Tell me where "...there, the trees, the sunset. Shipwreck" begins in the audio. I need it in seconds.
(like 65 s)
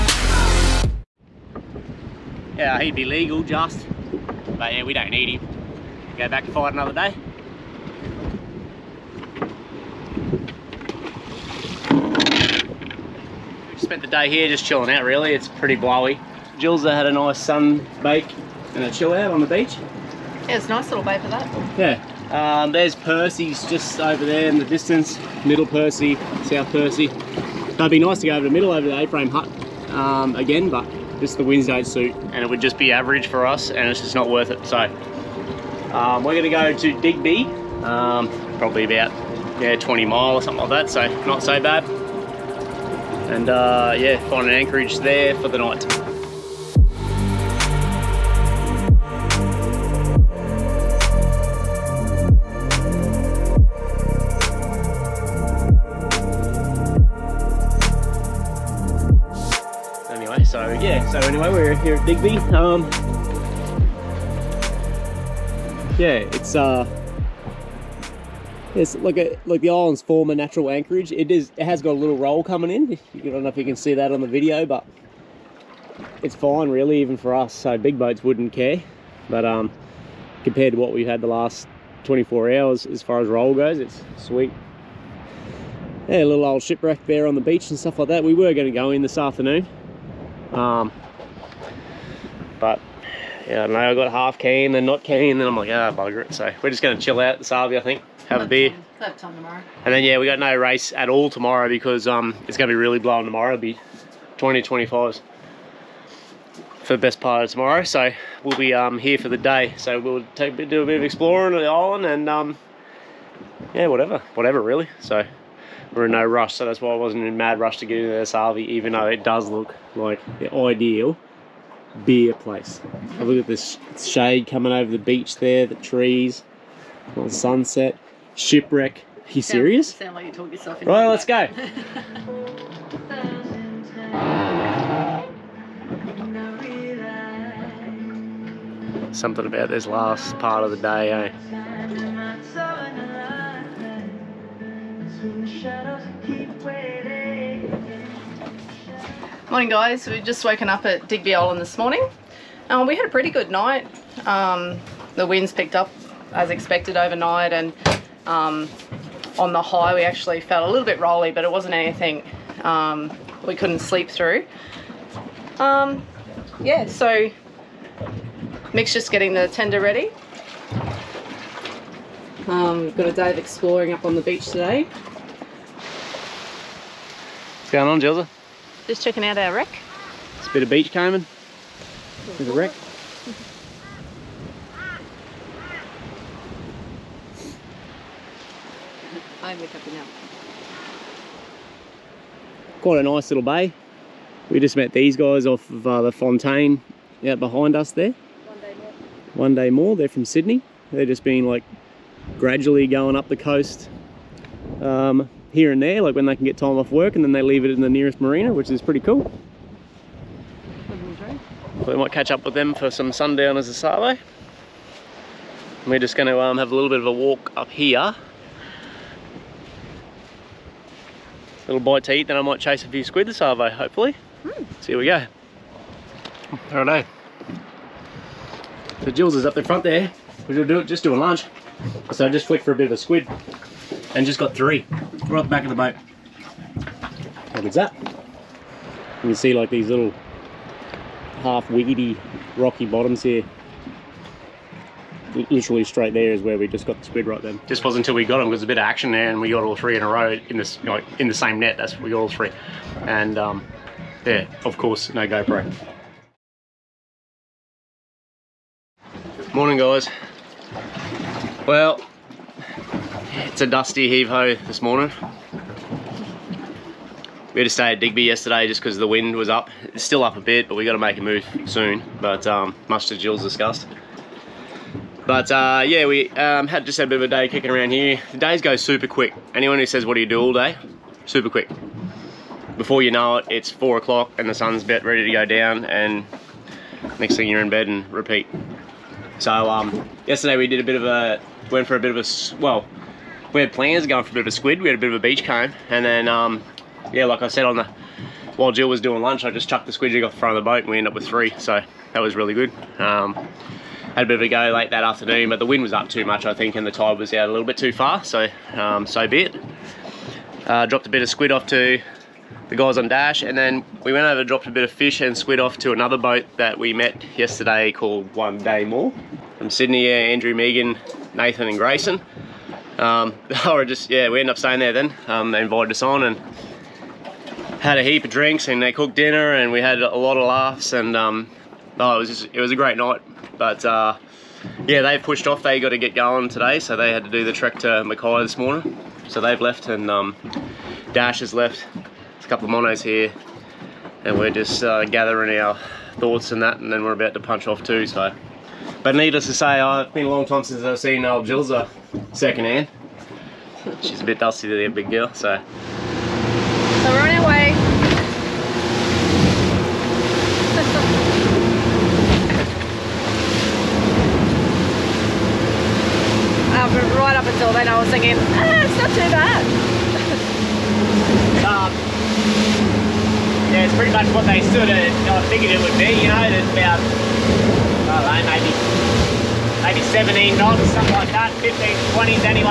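125 s.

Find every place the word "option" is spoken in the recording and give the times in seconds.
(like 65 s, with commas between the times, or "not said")
not said.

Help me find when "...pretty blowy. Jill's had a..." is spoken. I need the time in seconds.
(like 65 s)
15 s.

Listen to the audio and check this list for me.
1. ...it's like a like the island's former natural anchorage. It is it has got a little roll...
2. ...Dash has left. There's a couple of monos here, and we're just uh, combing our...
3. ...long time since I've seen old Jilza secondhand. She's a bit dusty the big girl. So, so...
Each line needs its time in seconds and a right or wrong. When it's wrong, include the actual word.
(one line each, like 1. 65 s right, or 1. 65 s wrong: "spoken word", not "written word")
1. 68 s right
2. 341 s wrong: "gathering", not "combing"
3. 350 s right.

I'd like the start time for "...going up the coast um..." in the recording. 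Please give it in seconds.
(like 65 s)
202 s.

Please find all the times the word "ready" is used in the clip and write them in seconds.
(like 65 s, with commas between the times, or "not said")
169 s, 285 s.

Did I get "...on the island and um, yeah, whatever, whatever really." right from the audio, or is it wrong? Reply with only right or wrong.
right.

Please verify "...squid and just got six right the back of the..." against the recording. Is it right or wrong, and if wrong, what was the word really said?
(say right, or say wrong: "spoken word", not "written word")
wrong: "three", not "six".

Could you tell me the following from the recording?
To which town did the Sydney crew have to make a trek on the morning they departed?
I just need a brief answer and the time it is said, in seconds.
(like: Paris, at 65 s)
Mackay, at 338 s.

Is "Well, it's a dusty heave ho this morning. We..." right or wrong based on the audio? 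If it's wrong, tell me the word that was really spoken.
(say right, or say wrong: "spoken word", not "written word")
right.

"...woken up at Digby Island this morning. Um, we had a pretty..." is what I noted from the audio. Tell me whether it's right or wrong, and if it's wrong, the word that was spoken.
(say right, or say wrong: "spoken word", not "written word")
right.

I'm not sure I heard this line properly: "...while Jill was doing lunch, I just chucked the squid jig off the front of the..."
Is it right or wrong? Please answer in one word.
right.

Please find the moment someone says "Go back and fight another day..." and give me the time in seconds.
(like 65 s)
6 s.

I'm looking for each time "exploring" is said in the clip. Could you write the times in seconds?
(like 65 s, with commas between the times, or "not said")
111 s, 173 s.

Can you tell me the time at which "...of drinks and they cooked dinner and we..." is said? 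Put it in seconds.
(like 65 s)
328 s.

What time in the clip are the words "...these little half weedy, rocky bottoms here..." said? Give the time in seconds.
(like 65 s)
239 s.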